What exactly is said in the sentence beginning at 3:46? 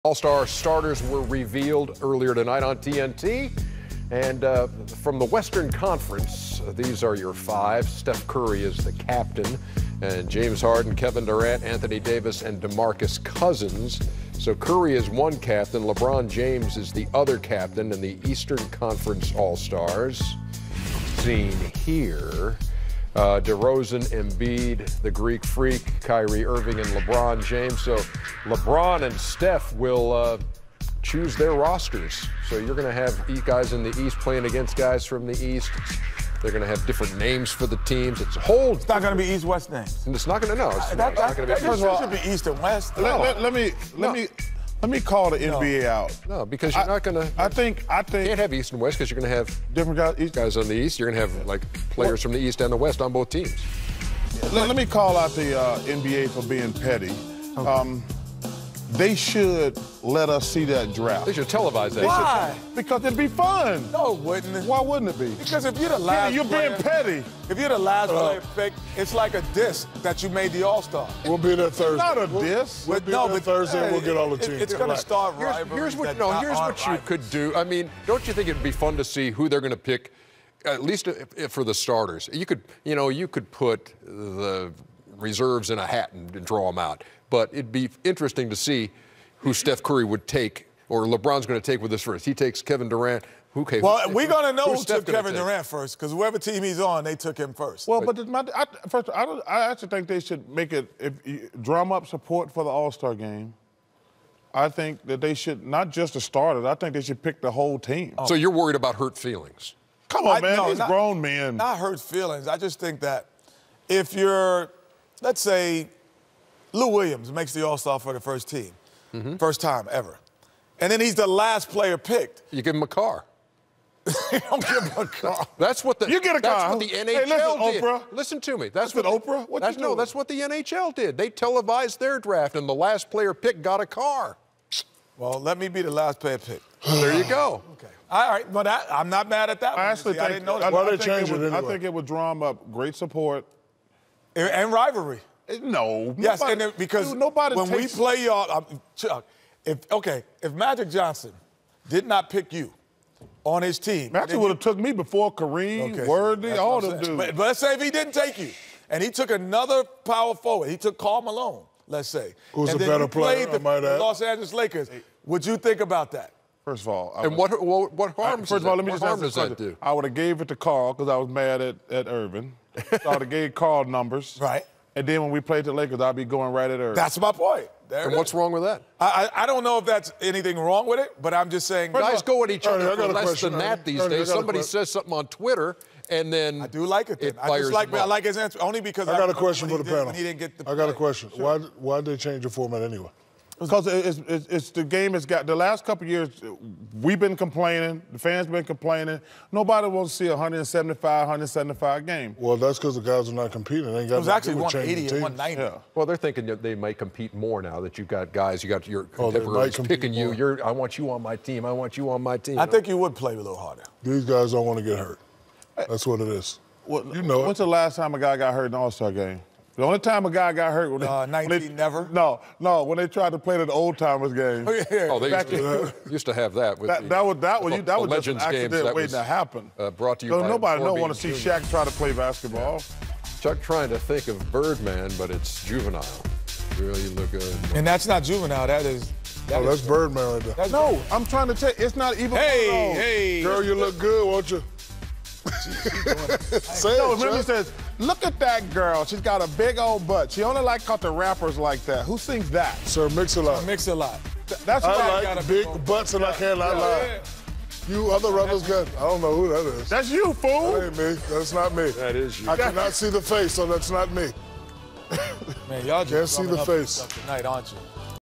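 that, the, that was that was, you, uh, that was just an accident games, waiting was, to happen.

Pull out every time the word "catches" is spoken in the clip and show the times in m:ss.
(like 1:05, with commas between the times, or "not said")
not said.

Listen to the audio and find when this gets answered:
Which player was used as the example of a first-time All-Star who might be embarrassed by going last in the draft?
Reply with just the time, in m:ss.
1:56.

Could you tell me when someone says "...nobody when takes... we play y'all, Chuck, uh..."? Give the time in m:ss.
2:27.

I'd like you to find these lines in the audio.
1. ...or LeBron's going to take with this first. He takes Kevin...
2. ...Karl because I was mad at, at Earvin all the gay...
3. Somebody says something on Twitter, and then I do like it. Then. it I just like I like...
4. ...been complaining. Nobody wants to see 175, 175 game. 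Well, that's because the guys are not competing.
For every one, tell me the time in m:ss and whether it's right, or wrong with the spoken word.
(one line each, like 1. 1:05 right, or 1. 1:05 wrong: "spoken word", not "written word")
1. 1:30 right
2. 2:50 right
3. 3:04 right
4. 3:18 right.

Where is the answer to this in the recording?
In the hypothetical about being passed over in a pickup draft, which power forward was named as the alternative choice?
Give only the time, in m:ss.
2:40.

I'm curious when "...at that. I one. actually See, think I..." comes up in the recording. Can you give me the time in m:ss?
2:19.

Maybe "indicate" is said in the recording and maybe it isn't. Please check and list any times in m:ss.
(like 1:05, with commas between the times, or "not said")
not said.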